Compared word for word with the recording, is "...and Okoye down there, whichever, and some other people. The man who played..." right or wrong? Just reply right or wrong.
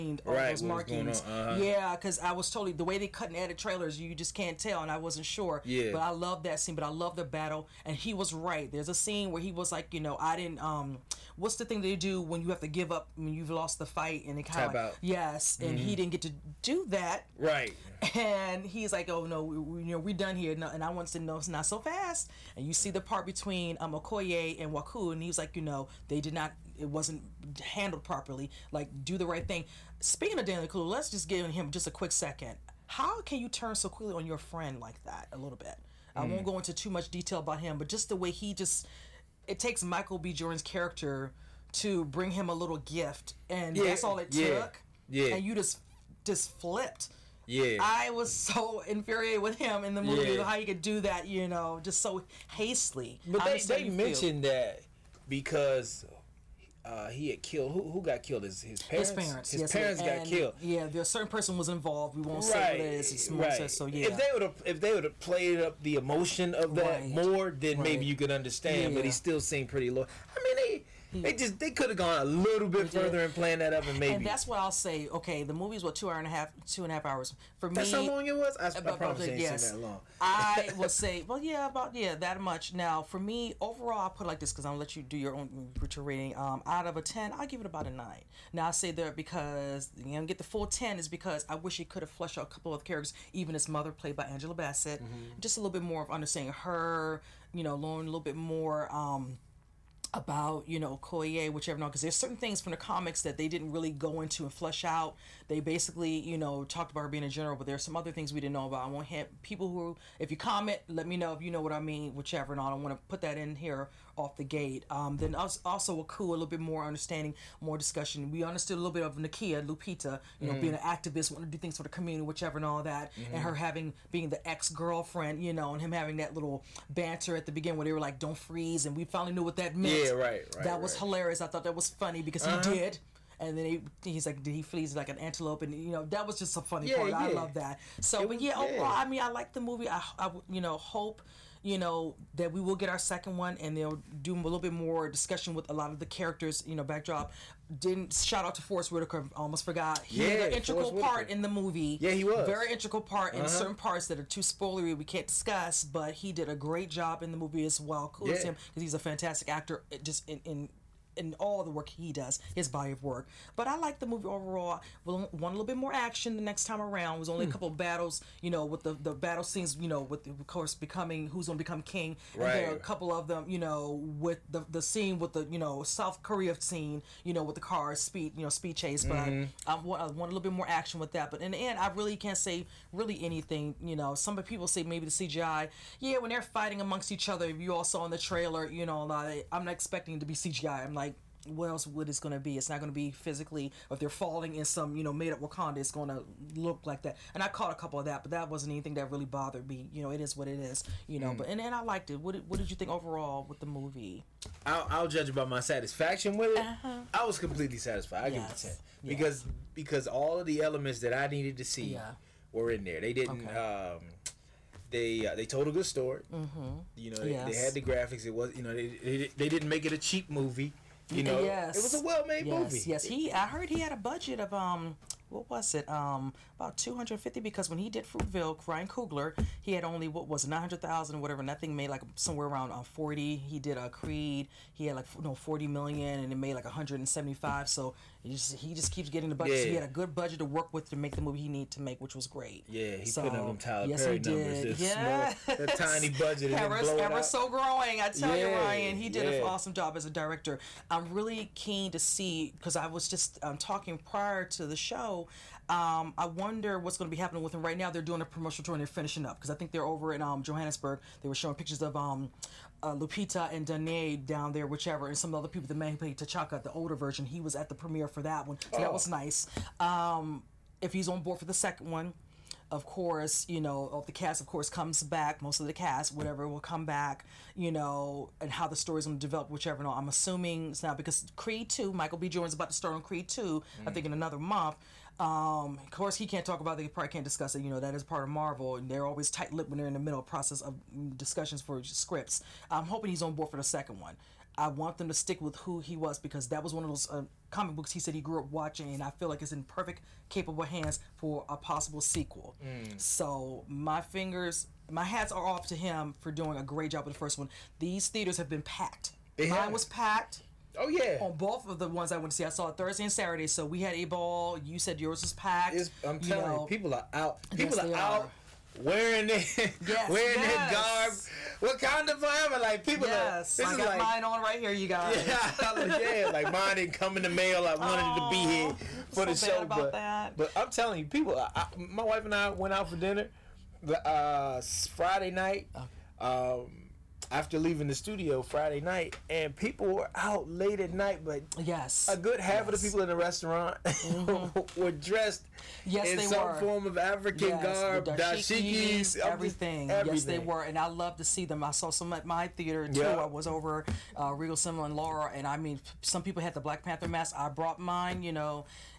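wrong.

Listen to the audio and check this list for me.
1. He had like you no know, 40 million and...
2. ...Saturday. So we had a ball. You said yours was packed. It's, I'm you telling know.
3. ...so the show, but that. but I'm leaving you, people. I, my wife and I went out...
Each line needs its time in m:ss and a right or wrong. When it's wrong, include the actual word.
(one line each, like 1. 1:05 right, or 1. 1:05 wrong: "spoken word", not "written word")
1. 3:54 right
2. 5:13 right
3. 5:29 wrong: "telling", not "leaving".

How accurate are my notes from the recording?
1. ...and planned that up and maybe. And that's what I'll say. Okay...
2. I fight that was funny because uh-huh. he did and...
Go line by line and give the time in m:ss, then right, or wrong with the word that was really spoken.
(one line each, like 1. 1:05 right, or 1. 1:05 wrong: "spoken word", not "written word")
1. 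1:13 right
2. 2:11 wrong: "thought", not "fight".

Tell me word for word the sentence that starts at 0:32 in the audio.
How can you turn so quickly on your friend like that a little bit?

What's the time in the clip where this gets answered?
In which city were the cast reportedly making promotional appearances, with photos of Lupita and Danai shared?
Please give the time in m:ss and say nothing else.
4:20.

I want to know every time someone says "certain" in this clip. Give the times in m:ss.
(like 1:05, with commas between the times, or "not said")
1:01, 1:42, 2:33.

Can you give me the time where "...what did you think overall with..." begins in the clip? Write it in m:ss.
3:22.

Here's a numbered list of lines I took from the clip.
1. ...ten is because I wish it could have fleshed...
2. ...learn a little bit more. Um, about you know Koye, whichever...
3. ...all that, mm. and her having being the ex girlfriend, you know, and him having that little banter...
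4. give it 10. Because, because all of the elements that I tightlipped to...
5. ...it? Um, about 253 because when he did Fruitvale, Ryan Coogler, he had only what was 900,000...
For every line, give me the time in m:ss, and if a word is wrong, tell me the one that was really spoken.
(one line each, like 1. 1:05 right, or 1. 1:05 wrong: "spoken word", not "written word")
1. 1:30 right
2. 1:37 right
3. 2:02 right
4. 3:28 wrong: "needed", not "tightlipped"
5. 3:45 wrong: "250", not "253".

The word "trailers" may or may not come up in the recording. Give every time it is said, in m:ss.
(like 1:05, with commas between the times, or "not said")
0:03, 3:08.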